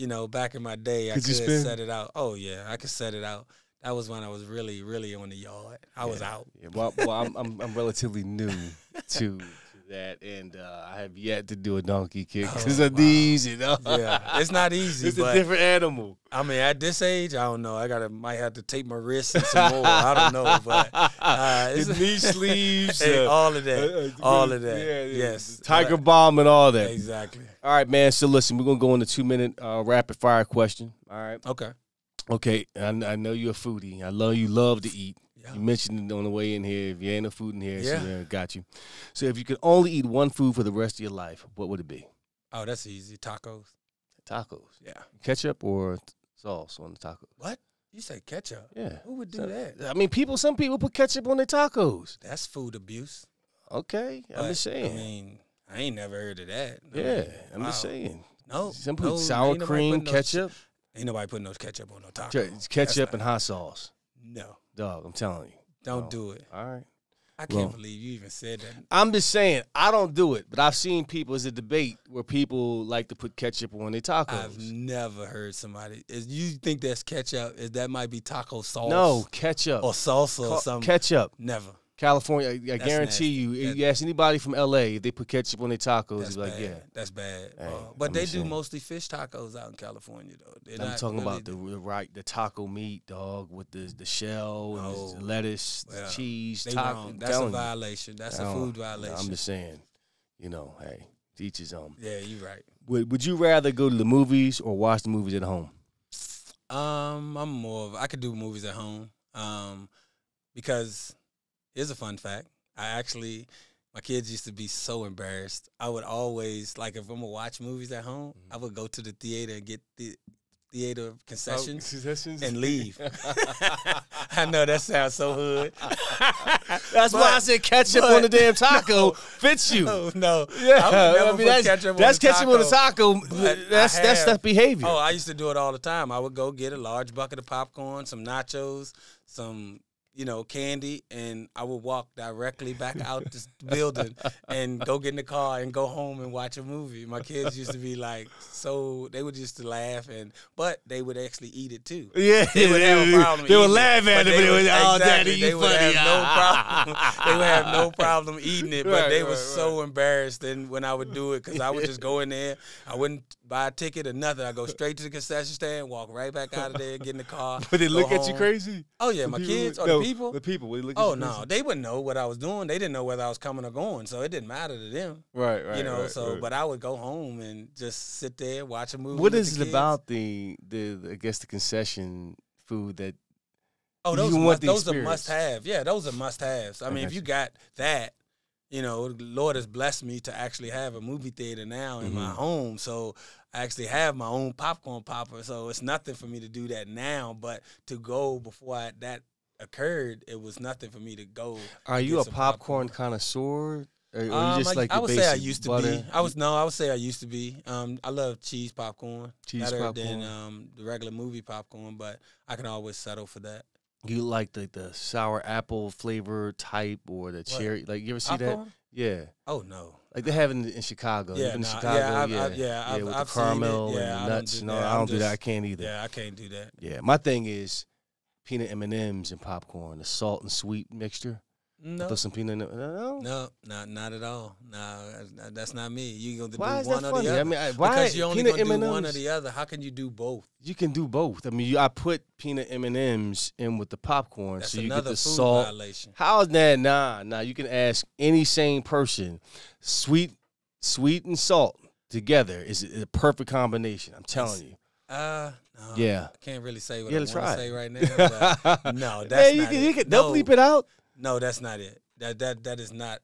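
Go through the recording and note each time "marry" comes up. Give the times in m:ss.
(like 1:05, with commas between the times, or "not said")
not said.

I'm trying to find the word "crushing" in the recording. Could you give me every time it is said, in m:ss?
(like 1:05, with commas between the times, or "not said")
not said.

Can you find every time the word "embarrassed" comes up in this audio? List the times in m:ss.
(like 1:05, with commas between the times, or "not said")
1:55, 2:39.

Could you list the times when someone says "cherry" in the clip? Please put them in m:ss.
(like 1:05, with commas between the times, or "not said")
3:37.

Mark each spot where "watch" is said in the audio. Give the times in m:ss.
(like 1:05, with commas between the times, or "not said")
1:44, 1:57, 2:26, 2:58.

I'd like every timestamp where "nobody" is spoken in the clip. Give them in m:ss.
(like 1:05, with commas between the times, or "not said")
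1:01.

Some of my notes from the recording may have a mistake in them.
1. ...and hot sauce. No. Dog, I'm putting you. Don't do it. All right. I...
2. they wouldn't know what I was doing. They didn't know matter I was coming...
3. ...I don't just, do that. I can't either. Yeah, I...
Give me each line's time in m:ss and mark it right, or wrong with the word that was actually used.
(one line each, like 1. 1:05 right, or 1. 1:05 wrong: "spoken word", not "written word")
1. 1:03 wrong: "telling", not "putting"
2. 2:51 wrong: "whether", not "matter"
3. 3:44 right.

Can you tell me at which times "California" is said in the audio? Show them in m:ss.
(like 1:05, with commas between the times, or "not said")
1:21, 1:29.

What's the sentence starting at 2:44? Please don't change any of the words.
I go straight to the concession stand, walk right back out of there, get in the car.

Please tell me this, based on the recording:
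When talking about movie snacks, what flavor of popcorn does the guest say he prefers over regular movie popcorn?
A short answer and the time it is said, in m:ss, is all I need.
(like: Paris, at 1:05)
Cheese popcorn, at 3:28.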